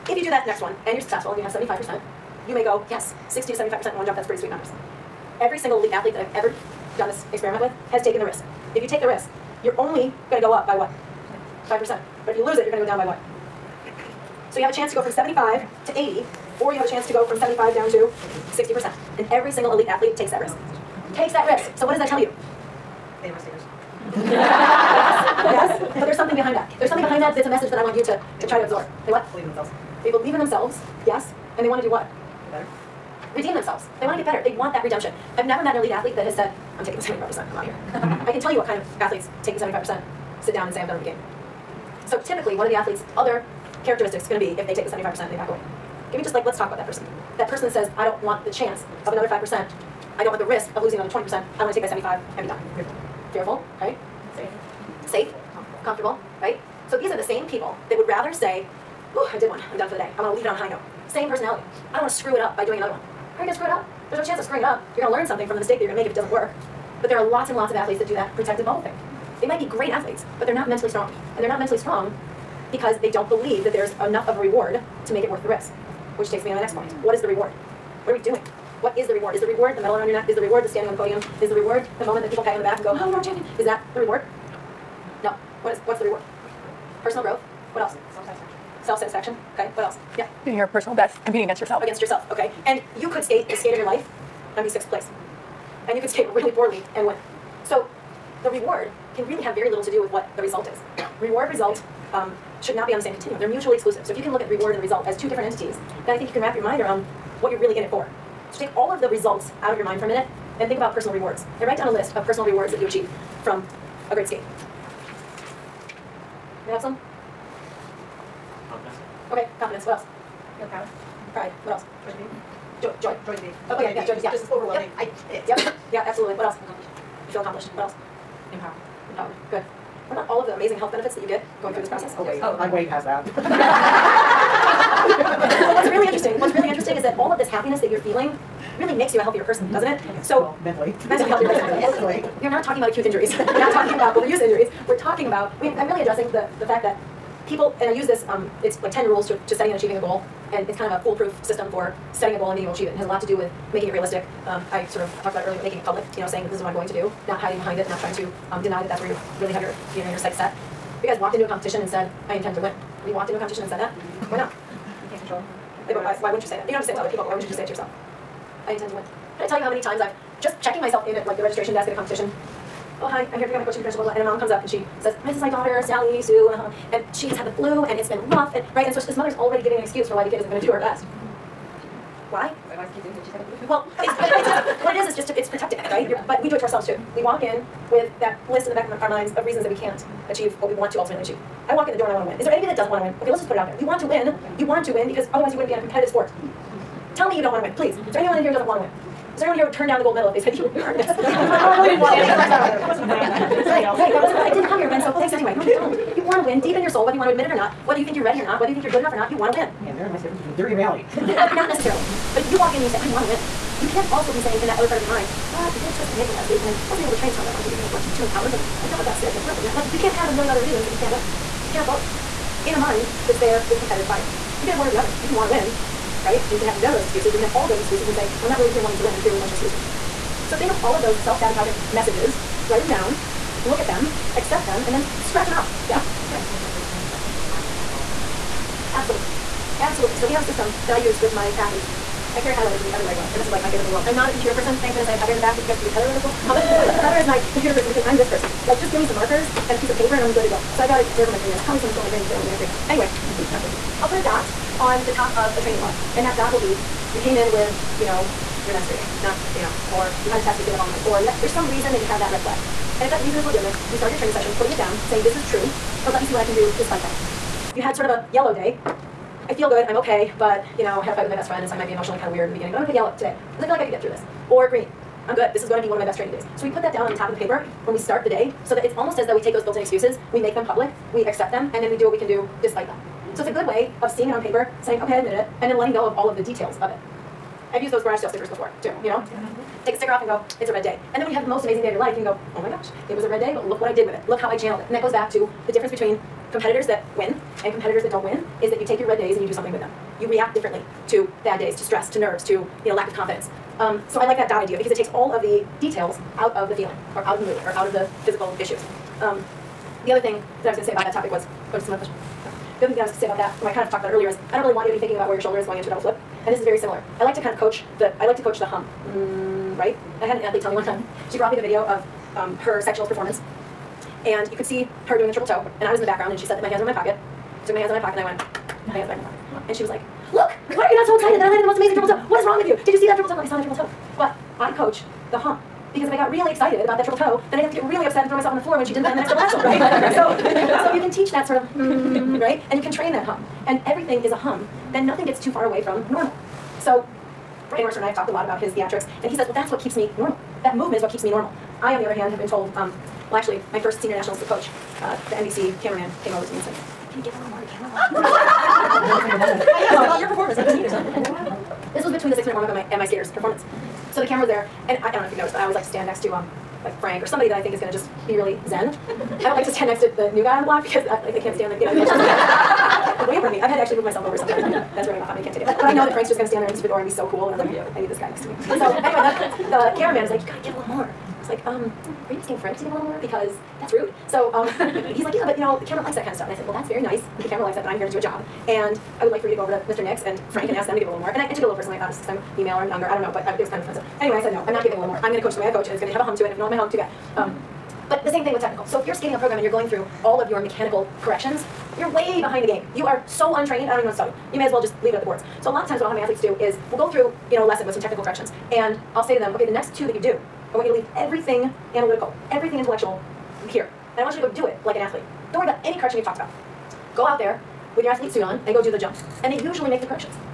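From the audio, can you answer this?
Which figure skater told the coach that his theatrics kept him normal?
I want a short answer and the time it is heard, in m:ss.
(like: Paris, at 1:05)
Brian Orser, at 5:47.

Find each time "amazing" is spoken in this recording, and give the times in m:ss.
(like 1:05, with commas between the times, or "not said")
2:10, 4:51, 5:31.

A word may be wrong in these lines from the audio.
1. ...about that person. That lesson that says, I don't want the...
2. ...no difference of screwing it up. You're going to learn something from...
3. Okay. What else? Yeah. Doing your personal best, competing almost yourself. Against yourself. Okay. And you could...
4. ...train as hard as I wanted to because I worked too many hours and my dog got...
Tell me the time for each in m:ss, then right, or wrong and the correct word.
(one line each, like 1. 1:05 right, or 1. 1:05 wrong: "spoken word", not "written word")
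1. 0:46 wrong: "person", not "lesson"
2. 1:04 wrong: "chance", not "difference"
3. 1:29 wrong: "against", not "almost"
4. 3:37 right.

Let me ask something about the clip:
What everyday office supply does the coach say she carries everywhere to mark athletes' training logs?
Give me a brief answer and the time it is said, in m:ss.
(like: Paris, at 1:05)
highlighters, at 4:02.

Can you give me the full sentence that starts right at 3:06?
You're, but we do it to ourselves too.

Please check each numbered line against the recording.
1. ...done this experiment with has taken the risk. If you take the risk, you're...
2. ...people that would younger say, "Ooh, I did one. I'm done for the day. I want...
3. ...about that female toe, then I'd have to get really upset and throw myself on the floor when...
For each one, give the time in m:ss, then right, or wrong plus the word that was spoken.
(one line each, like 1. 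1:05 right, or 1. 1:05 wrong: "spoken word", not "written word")
1. 0:06 right
2. 0:57 wrong: "rather", not "younger"
3. 5:36 wrong: "triple", not "female".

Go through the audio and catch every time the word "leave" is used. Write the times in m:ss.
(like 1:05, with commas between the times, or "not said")
1:00, 6:45, 6:50.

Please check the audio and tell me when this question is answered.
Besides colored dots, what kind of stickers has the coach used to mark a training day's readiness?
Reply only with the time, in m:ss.
4:48.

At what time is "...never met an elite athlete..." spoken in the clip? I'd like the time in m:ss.
0:35.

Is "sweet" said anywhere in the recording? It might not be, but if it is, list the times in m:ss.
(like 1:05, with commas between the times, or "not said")
0:04.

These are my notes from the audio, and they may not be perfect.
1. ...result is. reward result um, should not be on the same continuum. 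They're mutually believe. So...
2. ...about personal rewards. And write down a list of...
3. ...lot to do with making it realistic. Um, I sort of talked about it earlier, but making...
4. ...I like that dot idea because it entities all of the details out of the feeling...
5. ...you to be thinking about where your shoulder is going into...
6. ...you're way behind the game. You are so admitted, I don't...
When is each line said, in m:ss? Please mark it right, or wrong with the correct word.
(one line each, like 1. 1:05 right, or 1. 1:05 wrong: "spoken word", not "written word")
1. 1:40 wrong: "exclusive", not "believe"
2. 1:50 right
3. 2:33 right
4. 5:04 wrong: "takes", not "entities"
5. 5:14 right
6. 6:41 wrong: "untrained", not "admitted".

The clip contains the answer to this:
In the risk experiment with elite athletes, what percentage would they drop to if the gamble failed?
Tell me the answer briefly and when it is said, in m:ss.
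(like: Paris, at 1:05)
60%, at 0:17.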